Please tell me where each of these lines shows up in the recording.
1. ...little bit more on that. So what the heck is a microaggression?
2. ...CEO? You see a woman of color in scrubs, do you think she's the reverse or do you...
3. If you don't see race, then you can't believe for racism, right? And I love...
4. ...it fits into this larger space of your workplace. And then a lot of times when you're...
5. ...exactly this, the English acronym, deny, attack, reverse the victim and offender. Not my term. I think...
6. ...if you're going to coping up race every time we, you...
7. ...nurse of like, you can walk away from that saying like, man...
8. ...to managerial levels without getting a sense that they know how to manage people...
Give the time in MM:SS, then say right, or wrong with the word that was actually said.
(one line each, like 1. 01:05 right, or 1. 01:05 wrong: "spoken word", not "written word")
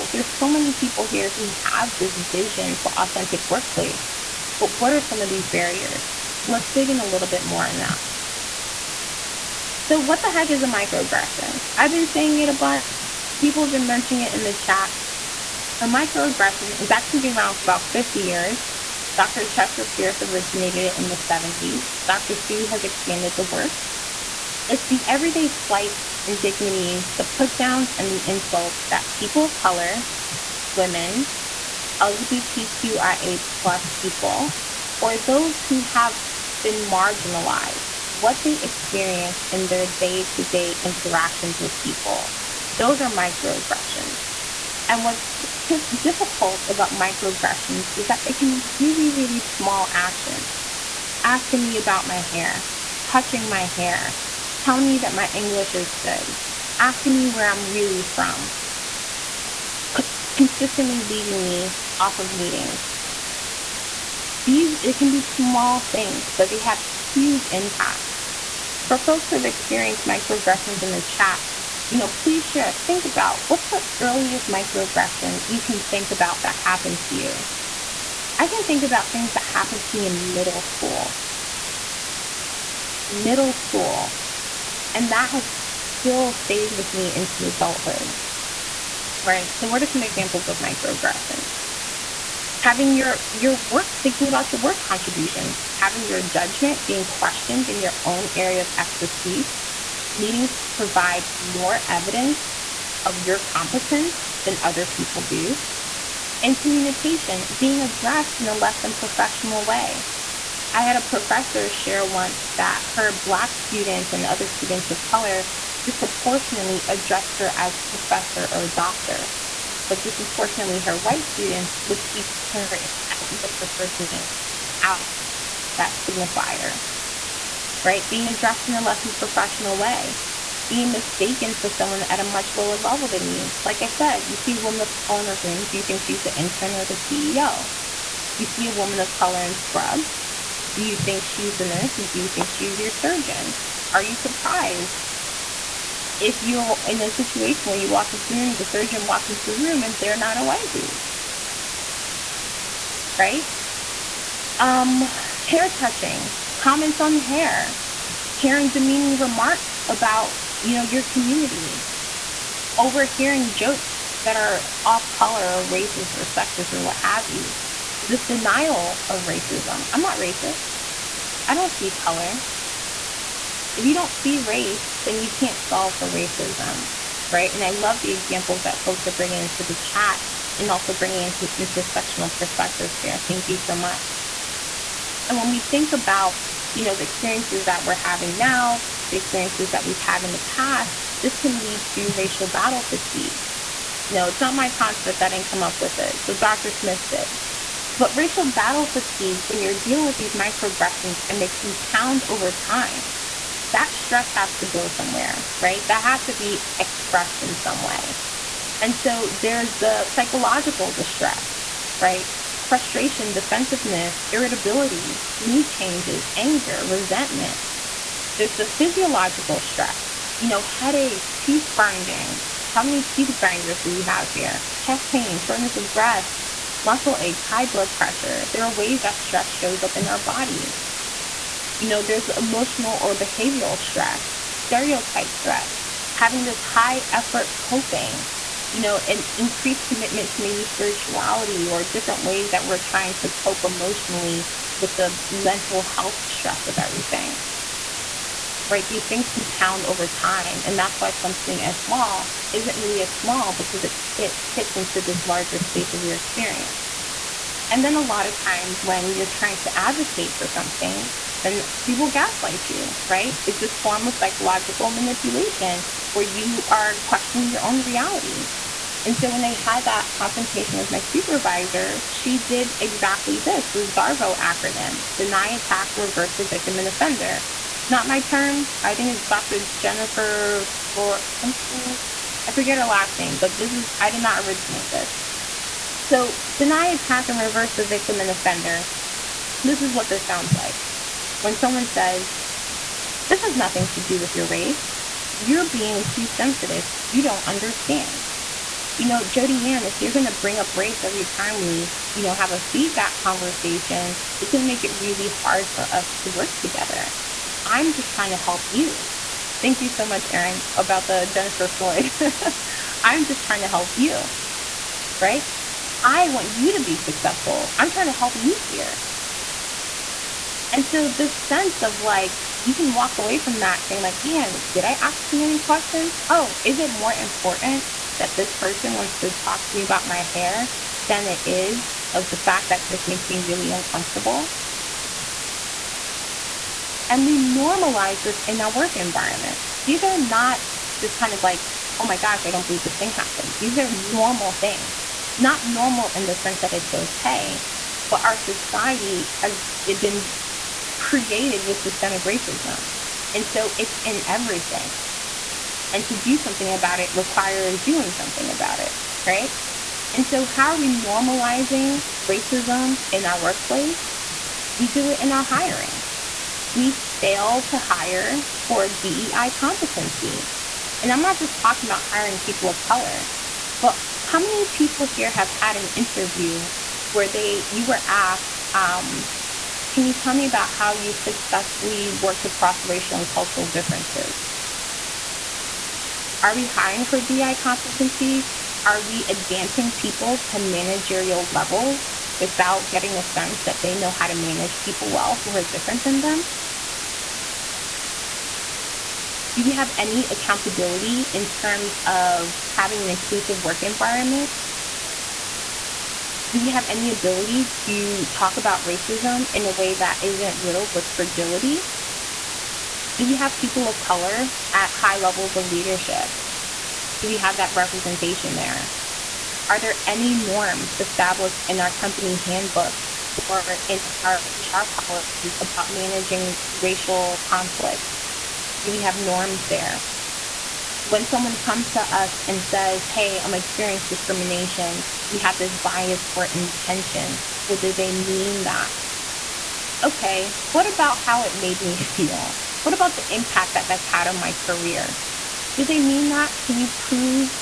1. 00:07 right
2. 02:17 wrong: "nurse", not "reverse"
3. 02:53 wrong: "solve", not "believe"
4. 04:14 wrong: "experience", not "workplace"
5. 04:32 wrong: "DARVO", not "English"
6. 04:59 wrong: "bring", not "coping"
7. 05:21 wrong: "sense", not "nurse"
8. 06:30 right.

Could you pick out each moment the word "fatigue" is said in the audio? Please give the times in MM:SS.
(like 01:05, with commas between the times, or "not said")
03:12, 03:18.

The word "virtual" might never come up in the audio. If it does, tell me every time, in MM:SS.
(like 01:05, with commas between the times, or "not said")
not said.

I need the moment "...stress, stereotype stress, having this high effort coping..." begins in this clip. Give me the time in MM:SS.
03:53.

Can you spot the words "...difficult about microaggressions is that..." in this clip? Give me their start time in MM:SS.
00:46.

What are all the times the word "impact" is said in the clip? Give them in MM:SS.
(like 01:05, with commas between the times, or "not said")
01:07, 07:23.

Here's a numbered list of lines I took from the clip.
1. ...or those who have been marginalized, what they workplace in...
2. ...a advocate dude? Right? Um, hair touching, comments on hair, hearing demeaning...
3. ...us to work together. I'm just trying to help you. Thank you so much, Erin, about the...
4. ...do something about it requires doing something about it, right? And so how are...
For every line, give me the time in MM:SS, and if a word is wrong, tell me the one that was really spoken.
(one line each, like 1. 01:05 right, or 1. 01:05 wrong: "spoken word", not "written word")
1. 00:34 wrong: "experience", not "workplace"
2. 02:30 wrong: "white", not "advocate"
3. 05:05 right
4. 05:56 right.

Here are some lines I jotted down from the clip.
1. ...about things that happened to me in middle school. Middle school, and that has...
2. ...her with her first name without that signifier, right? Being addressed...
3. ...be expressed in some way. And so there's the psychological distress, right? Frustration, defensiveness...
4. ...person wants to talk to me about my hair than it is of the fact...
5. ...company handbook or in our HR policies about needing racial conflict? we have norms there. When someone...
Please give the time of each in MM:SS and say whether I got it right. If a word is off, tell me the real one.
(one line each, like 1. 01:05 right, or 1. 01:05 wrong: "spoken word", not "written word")
1. 01:18 right
2. 02:02 right
3. 03:26 right
4. 05:28 right
5. 07:01 wrong: "managing", not "needing".